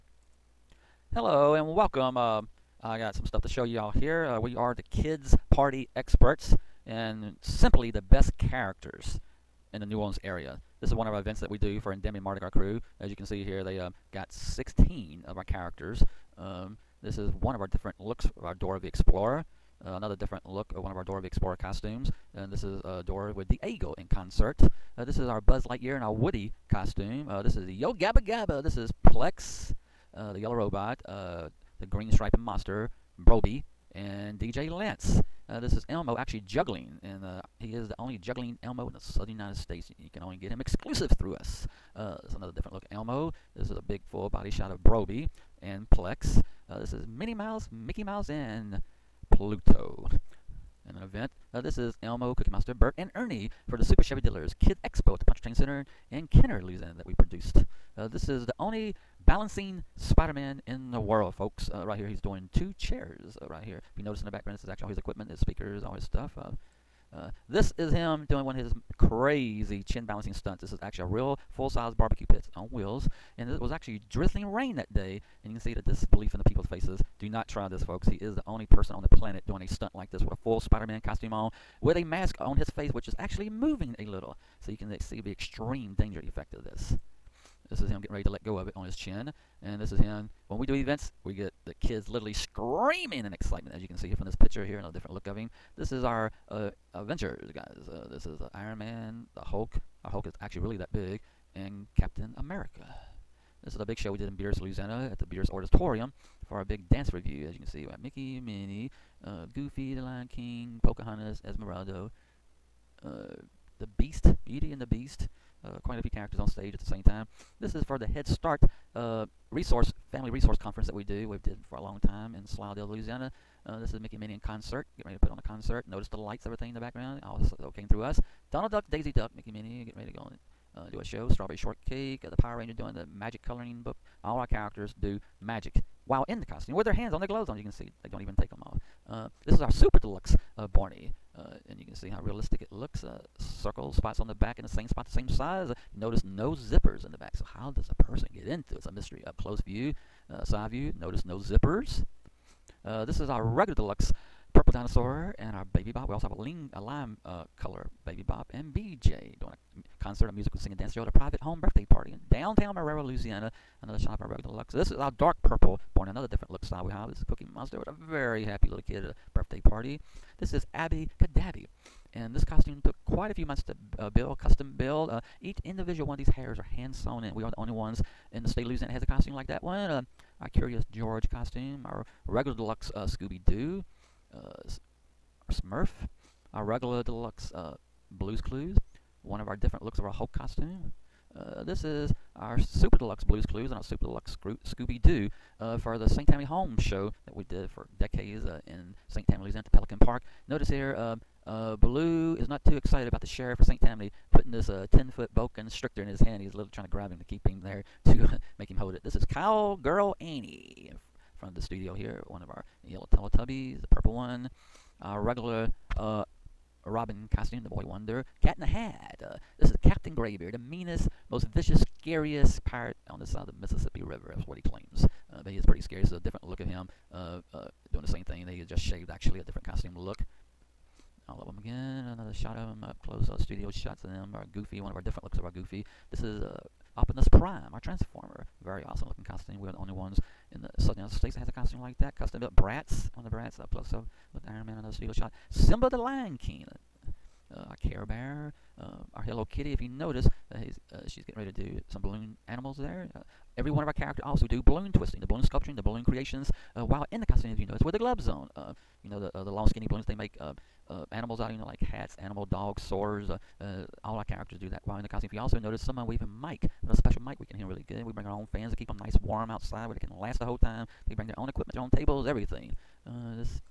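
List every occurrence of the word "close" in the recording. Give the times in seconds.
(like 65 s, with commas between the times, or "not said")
149 s, 233 s, 243 s.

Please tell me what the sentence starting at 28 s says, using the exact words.
This is Plex, uh, the Yellow Robot, uh, the Green Stripe and Monster, Brobee, and DJ Lance.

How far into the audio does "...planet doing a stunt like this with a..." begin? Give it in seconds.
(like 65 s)
79 s.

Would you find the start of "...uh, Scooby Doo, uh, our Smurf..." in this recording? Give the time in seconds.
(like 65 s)
182 s.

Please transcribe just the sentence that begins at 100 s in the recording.
Our Hulk is actually really that big, and Captain America.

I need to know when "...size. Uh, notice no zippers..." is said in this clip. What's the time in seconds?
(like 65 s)
145 s.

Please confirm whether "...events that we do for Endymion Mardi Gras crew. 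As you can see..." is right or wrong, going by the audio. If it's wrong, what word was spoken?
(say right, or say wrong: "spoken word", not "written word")
right.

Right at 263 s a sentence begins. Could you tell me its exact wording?
Uh, all our characters do that while in the costume.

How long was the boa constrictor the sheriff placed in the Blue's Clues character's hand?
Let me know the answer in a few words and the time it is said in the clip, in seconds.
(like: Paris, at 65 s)
10 foot, at 204 s.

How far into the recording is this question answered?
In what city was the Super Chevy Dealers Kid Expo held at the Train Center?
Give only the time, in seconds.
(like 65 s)
56 s.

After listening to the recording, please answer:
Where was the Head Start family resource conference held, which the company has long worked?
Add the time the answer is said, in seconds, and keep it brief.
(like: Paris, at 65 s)
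Slidell, Louisiana, at 122 s.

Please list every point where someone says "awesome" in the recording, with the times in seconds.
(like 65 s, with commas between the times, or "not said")
238 s.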